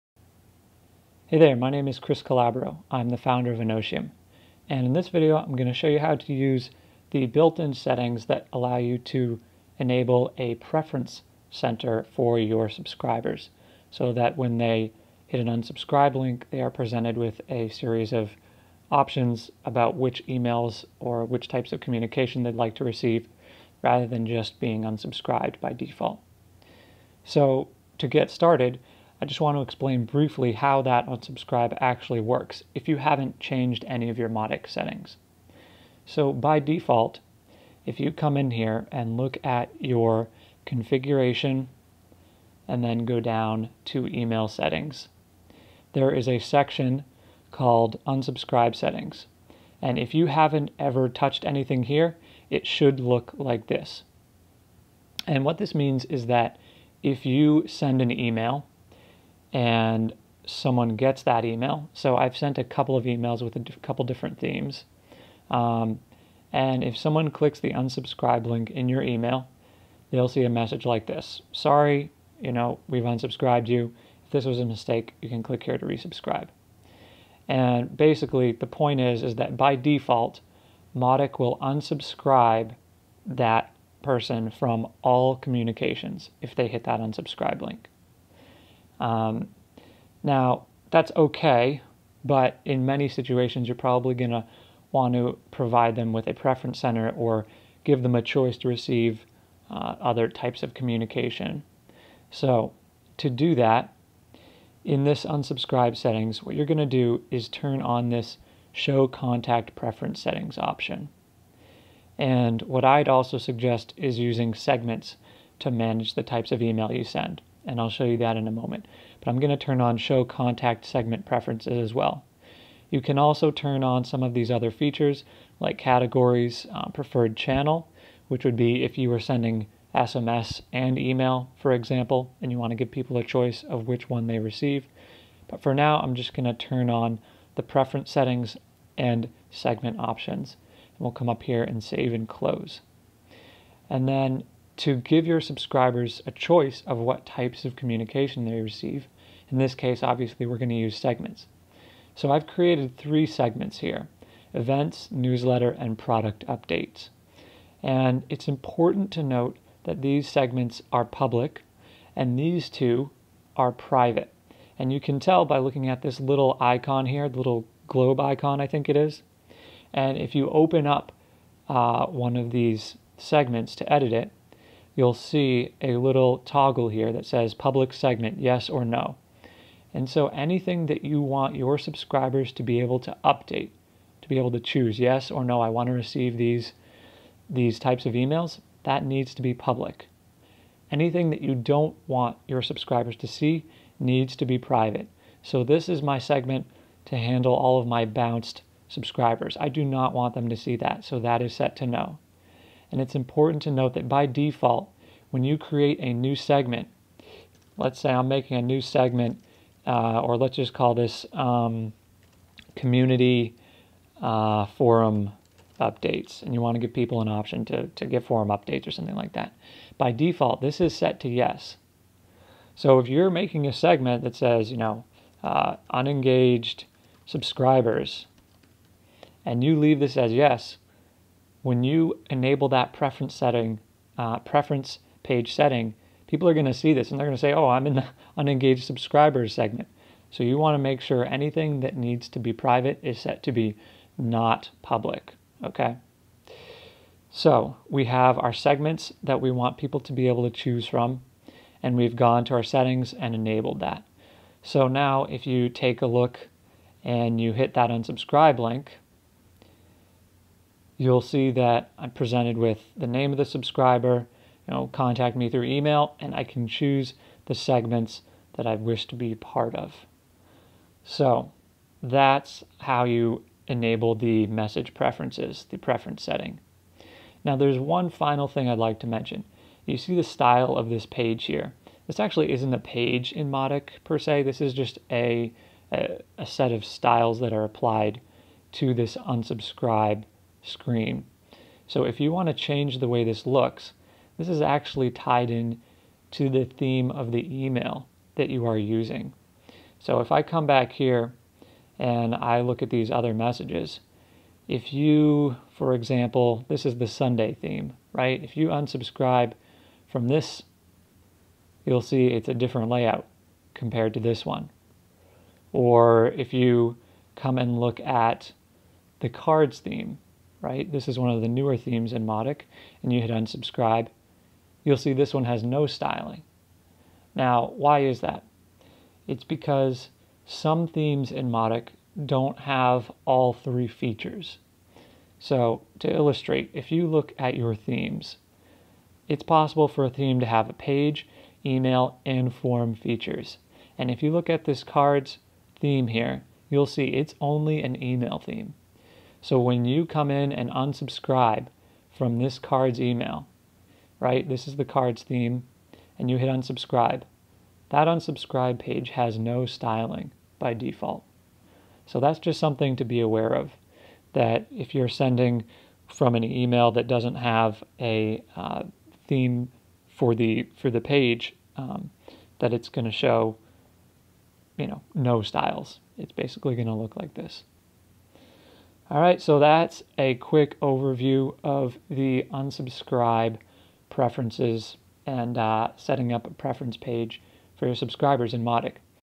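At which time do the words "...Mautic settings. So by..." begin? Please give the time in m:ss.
0:34.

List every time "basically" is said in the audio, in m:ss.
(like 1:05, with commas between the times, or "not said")
1:17, 6:16.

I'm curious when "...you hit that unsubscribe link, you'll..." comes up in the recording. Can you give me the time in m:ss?
4:17.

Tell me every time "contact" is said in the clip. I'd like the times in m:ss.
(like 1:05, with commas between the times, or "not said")
1:49, 2:00, 4:24.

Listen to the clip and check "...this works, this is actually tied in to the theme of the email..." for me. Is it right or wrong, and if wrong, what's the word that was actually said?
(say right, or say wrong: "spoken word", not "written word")
wrong: "looks", not "works".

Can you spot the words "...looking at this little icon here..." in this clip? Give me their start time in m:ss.
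2:45.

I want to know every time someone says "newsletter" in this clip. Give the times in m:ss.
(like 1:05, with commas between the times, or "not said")
2:35.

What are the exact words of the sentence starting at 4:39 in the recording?
You see the style of this page here.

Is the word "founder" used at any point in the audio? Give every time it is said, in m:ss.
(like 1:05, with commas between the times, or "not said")
0:03.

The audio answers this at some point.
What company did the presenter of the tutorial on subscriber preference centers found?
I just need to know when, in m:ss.
0:03.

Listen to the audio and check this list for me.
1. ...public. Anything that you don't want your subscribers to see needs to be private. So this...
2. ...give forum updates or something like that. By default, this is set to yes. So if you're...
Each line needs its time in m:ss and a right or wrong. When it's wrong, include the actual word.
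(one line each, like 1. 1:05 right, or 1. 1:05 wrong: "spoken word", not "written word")
1. 3:09 right
2. 3:38 right.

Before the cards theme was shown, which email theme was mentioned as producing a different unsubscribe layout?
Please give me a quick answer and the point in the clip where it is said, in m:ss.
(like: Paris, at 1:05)
Sunday, at 5:07.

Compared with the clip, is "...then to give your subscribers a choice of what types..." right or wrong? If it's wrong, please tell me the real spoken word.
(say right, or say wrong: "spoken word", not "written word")
right.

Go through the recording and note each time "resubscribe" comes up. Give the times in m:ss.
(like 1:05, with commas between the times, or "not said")
1:15.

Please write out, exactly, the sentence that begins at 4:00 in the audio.
So you want to make sure anything that needs to be private is set to be not public.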